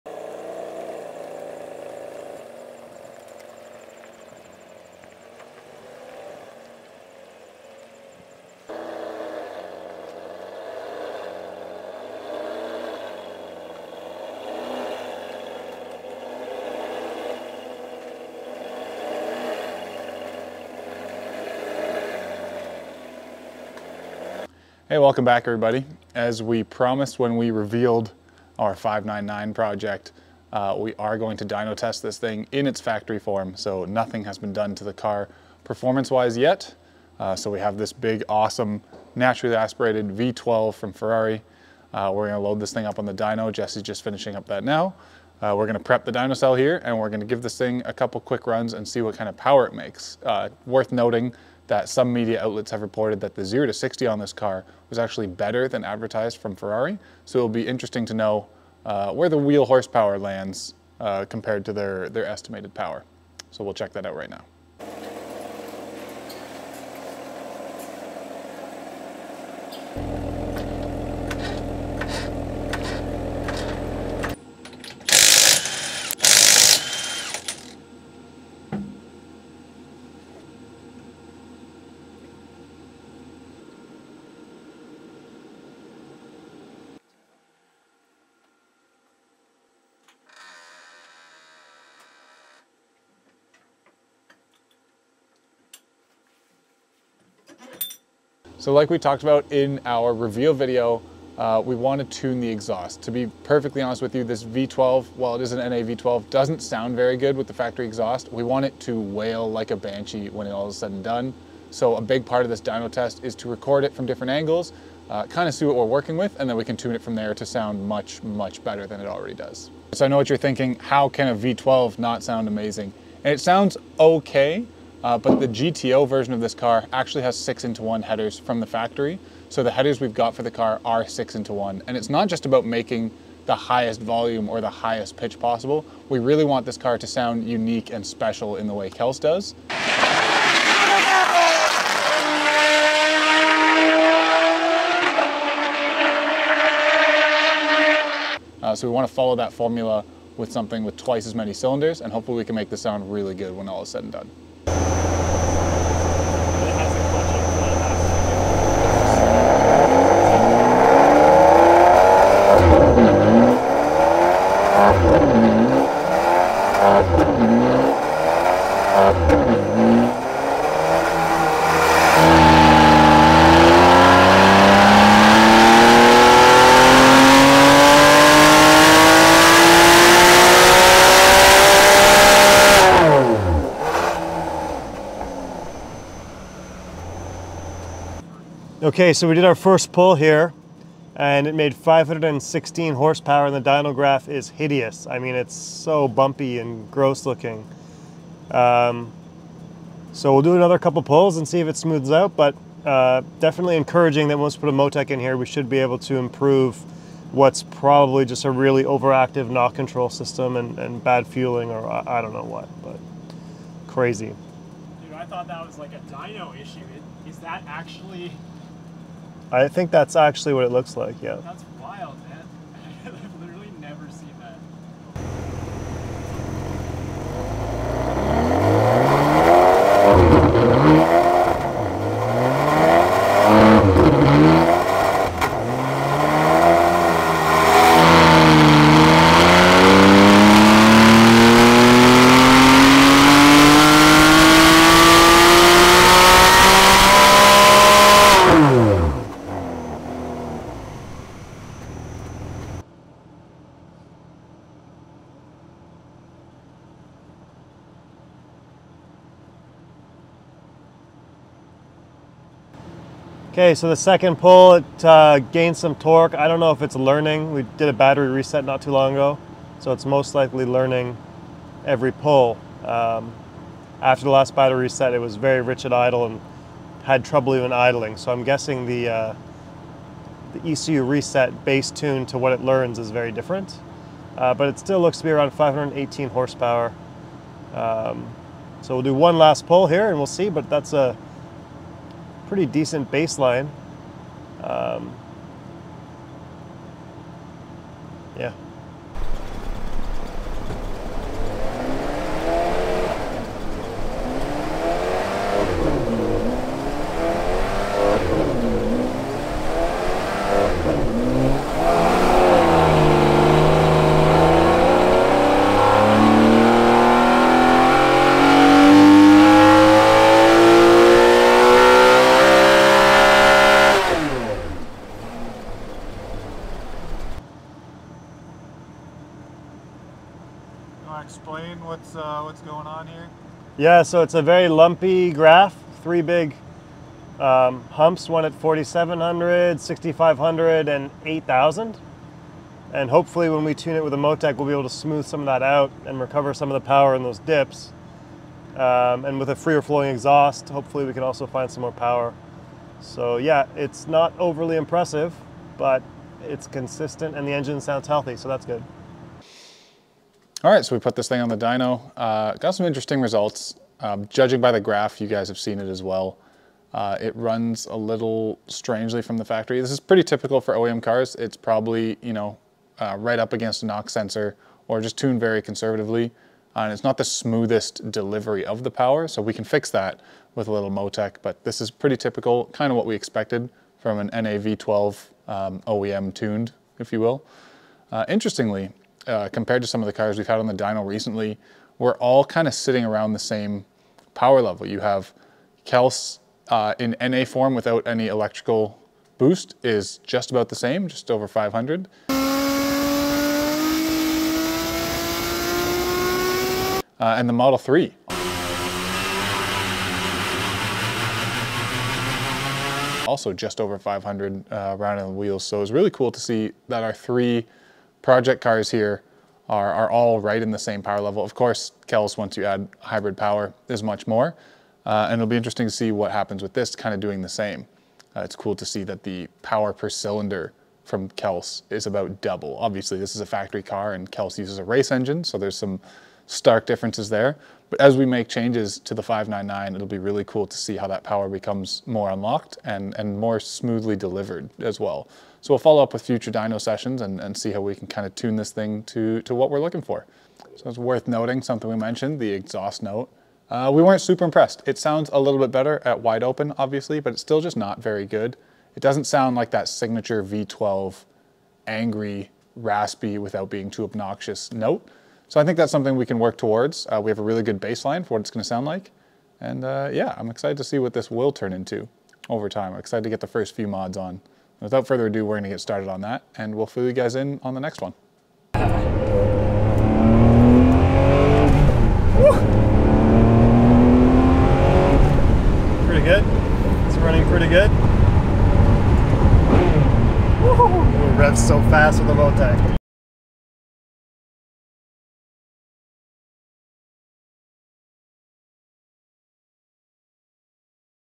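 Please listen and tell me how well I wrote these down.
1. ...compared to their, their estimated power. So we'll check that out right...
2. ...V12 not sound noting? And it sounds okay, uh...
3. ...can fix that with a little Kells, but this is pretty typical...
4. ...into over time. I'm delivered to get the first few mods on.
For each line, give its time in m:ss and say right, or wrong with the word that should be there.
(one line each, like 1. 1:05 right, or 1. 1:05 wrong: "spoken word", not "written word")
1. 1:01 right
2. 2:01 wrong: "amazing", not "noting"
3. 6:19 wrong: "MoTeC", not "Kells"
4. 7:51 wrong: "excited", not "delivered".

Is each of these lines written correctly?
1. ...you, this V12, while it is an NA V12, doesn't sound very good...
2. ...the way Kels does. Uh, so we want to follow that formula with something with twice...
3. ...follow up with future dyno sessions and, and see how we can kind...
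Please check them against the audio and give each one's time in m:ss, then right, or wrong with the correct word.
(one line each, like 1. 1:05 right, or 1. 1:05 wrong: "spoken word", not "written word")
1. 1:44 right
2. 2:18 right
3. 7:25 right.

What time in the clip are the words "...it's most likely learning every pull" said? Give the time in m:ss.
4:29.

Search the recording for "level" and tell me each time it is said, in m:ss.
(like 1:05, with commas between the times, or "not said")
6:34, 7:01.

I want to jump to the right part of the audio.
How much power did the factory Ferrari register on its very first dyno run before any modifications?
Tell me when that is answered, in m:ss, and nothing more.
3:11.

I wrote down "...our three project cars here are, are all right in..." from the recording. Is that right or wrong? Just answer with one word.
right.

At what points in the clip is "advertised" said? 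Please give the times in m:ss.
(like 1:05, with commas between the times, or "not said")
0:55.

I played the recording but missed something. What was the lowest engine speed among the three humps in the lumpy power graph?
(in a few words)
4,700.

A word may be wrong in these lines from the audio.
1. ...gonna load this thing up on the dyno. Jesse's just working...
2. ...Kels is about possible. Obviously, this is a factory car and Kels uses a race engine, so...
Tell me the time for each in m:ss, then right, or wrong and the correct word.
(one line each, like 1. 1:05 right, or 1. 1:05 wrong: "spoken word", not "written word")
1. 0:42 wrong: "finishing", not "working"
2. 7:11 wrong: "double", not "possible".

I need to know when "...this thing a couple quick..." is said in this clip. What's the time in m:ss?
0:47.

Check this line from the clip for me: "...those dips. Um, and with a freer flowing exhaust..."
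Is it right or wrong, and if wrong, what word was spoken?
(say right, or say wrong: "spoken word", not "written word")
right.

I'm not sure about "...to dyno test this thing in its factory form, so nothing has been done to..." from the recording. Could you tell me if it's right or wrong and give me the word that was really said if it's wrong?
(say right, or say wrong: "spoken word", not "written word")
right.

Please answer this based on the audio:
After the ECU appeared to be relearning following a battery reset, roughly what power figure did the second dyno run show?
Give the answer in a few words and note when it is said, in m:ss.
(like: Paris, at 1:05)
518 horsepower, at 4:45.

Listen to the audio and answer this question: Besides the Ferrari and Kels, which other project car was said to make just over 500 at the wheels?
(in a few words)
Model 3.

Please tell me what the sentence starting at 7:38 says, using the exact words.
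It doesn't sound like that signature V12 angry, raspy without being too obnoxious note.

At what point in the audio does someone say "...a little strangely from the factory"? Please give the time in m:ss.
6:07.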